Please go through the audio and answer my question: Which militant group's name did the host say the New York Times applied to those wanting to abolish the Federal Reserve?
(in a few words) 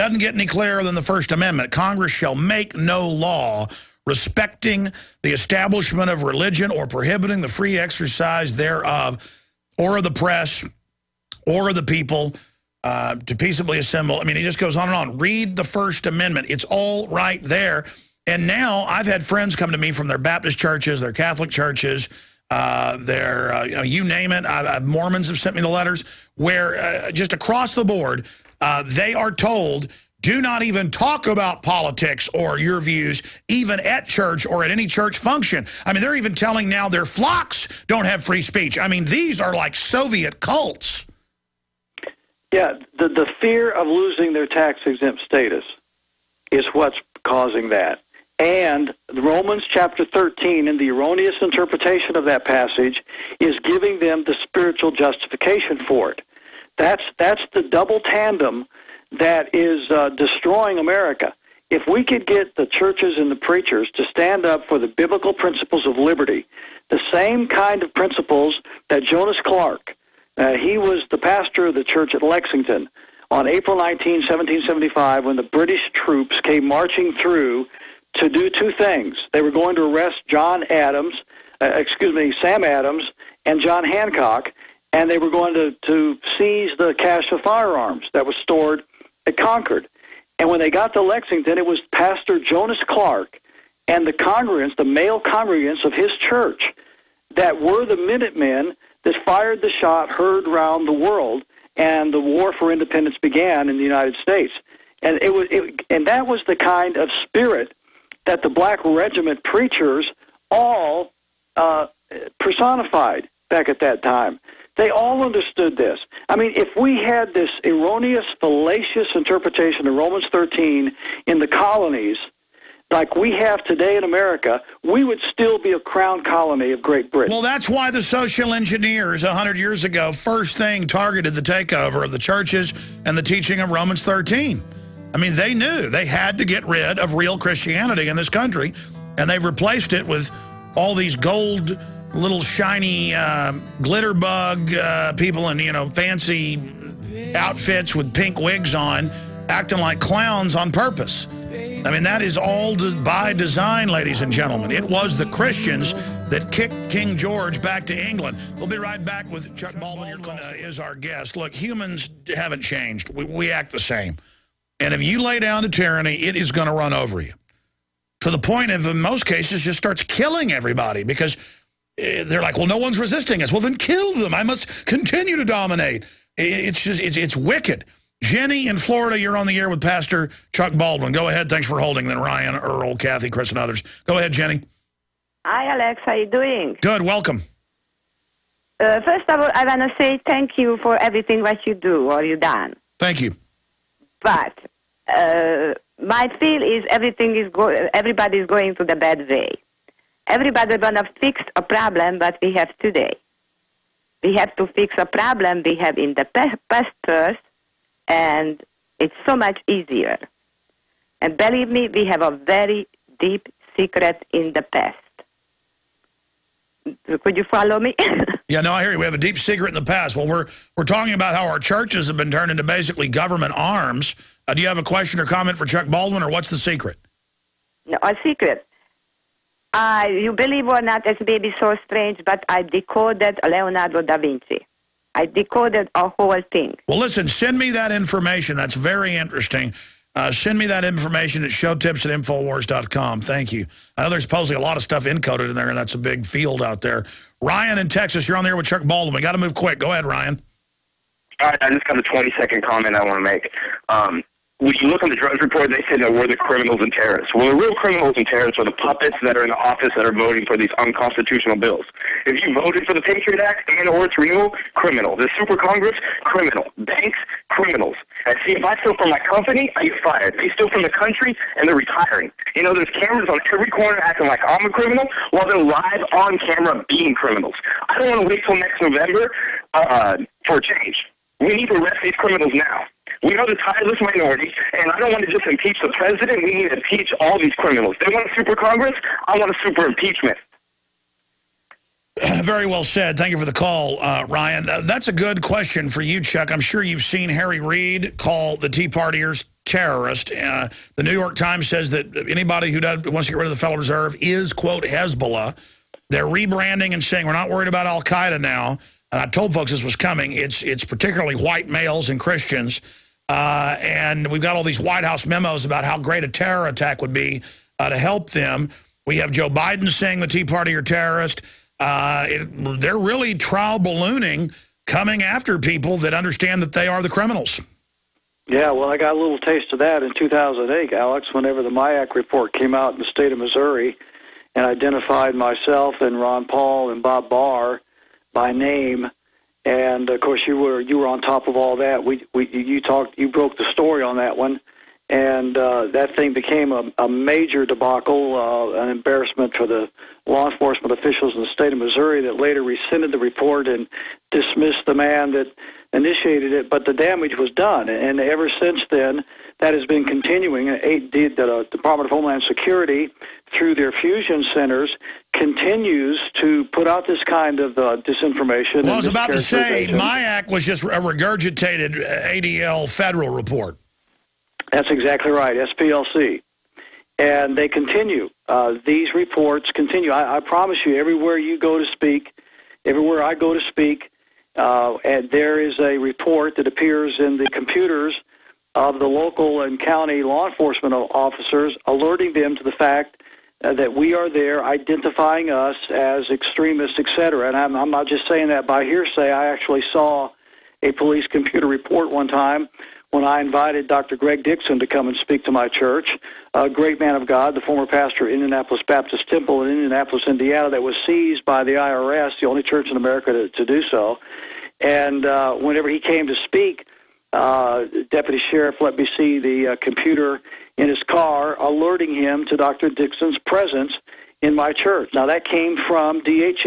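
Hezbollah.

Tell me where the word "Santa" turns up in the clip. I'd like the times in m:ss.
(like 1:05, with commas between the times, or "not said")
not said.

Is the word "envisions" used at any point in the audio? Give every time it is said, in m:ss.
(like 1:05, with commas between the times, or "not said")
not said.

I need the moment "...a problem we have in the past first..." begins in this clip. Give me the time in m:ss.
3:24.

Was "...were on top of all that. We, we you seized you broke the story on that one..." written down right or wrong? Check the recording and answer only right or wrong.
wrong.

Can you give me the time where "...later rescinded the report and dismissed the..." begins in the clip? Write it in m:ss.
5:52.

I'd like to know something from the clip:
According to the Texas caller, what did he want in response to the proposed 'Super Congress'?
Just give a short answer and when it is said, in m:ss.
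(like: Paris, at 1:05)
A super impeachment, at 4:49.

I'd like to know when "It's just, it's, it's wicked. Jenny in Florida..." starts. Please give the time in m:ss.
2:56.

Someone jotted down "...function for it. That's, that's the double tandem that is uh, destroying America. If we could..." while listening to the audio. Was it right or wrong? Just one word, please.
wrong.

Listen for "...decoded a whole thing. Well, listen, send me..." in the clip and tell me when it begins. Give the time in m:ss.
3:55.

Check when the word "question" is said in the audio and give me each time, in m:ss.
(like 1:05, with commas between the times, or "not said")
3:44, 4:55.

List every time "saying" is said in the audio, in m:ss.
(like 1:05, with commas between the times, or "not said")
5:07, 5:19, 6:38.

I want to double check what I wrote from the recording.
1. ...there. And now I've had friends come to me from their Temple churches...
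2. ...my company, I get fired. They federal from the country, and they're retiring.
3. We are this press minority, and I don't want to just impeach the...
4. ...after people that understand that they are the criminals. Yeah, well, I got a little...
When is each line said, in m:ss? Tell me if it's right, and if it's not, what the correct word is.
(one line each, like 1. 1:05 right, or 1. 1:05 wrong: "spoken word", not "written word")
1. 0:17 wrong: "Baptist", not "Temple"
2. 4:29 wrong: "steal", not "federal"
3. 4:43 wrong: "tireless", not "press"
4. 5:25 right.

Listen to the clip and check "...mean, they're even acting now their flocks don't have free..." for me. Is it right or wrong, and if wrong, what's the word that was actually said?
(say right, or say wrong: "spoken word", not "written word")
wrong: "telling", not "acting".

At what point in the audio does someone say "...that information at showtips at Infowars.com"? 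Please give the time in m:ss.
4:00.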